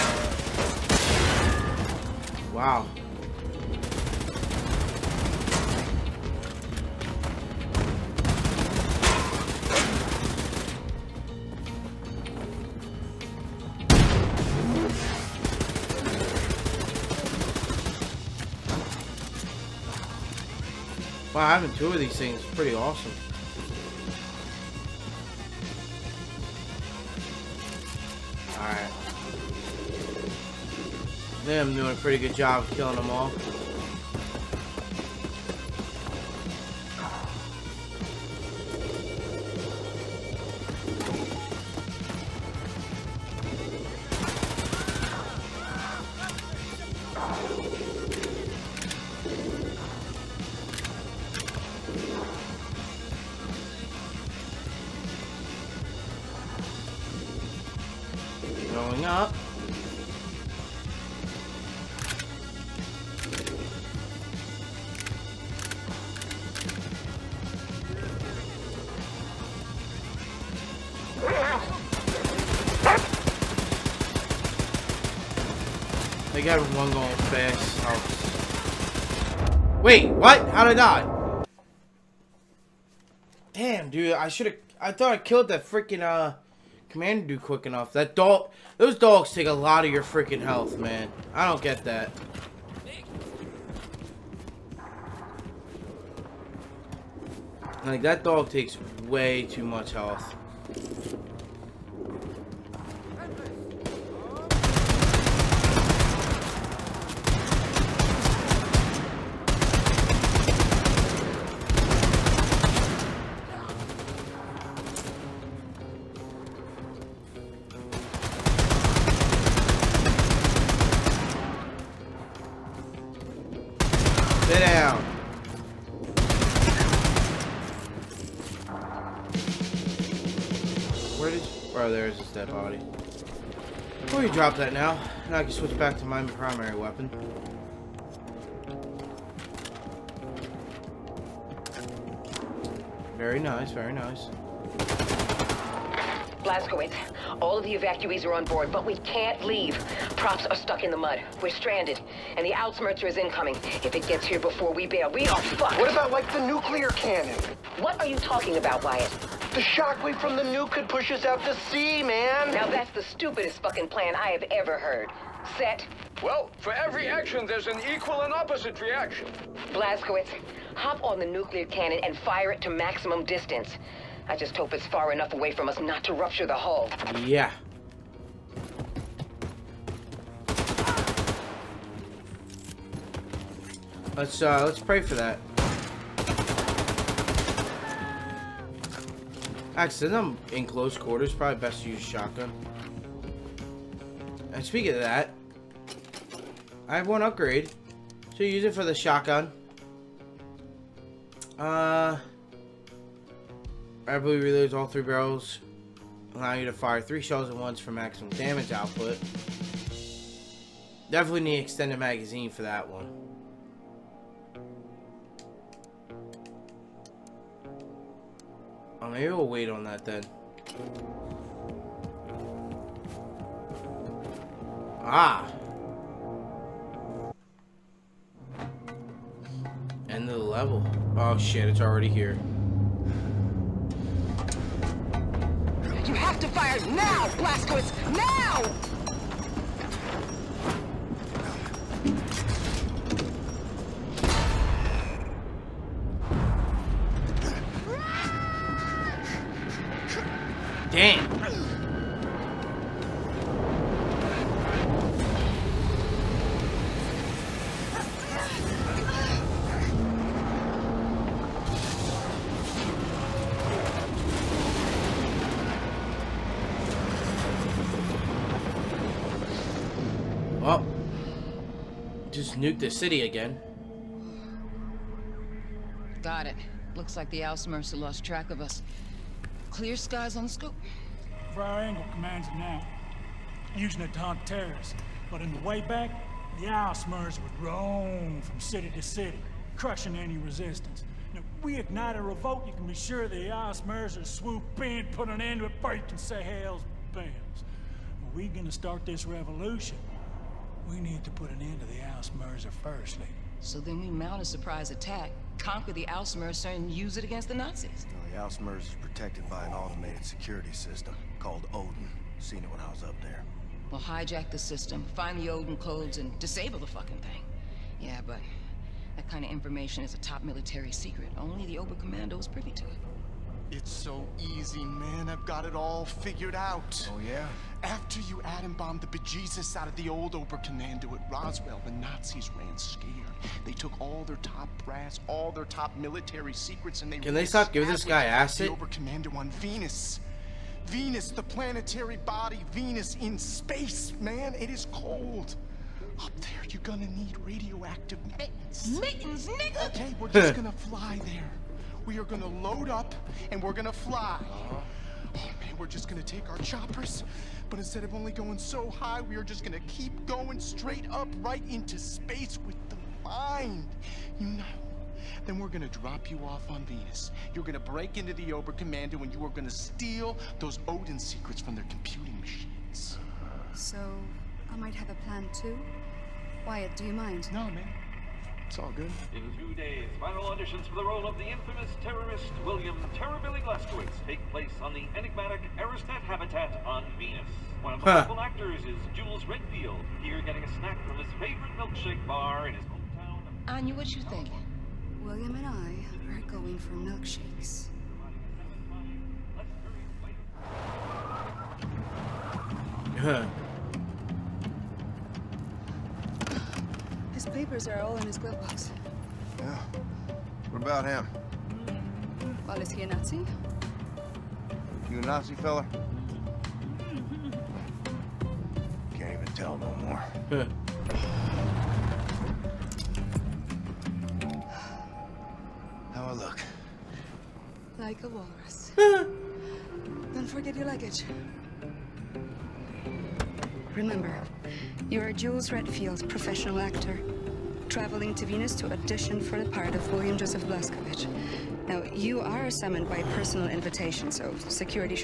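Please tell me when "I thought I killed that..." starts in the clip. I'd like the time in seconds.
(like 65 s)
84 s.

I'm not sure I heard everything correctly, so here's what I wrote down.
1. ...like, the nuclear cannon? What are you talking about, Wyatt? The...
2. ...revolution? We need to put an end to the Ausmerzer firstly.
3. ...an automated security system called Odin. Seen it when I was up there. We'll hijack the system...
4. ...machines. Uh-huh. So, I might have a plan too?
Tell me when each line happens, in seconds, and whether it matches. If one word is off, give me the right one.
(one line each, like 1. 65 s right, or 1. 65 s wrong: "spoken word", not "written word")
1. 156 s right
2. 299 s right
3. 309 s right
4. 372 s right.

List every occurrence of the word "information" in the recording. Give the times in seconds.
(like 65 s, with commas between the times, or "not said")
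319 s.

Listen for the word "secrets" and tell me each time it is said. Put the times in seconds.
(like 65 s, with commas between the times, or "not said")
320 s, 336 s, 371 s.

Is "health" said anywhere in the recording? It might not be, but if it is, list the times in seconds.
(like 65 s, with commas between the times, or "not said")
90 s, 99 s.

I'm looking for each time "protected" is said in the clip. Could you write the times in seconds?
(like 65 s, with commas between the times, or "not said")
309 s.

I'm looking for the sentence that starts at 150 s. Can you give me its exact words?
Props are stuck in the mud.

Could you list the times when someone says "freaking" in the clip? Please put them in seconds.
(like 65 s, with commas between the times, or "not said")
85 s, 90 s.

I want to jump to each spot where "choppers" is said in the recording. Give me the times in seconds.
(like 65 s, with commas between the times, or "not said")
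356 s.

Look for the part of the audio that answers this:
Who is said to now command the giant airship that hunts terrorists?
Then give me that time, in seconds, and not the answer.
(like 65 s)
281 s.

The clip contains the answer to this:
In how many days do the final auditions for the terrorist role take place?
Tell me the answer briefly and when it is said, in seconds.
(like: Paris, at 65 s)
2, at 379 s.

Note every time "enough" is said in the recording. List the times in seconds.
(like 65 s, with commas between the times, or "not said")
87 s, 175 s.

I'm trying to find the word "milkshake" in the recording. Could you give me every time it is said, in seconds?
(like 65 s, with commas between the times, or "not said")
391 s, 396 s.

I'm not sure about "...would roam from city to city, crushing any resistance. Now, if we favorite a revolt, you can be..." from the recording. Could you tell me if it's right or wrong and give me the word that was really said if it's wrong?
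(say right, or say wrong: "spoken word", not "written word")
wrong: "ignite", not "favorite".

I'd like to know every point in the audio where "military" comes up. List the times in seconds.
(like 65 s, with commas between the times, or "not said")
320 s, 335 s.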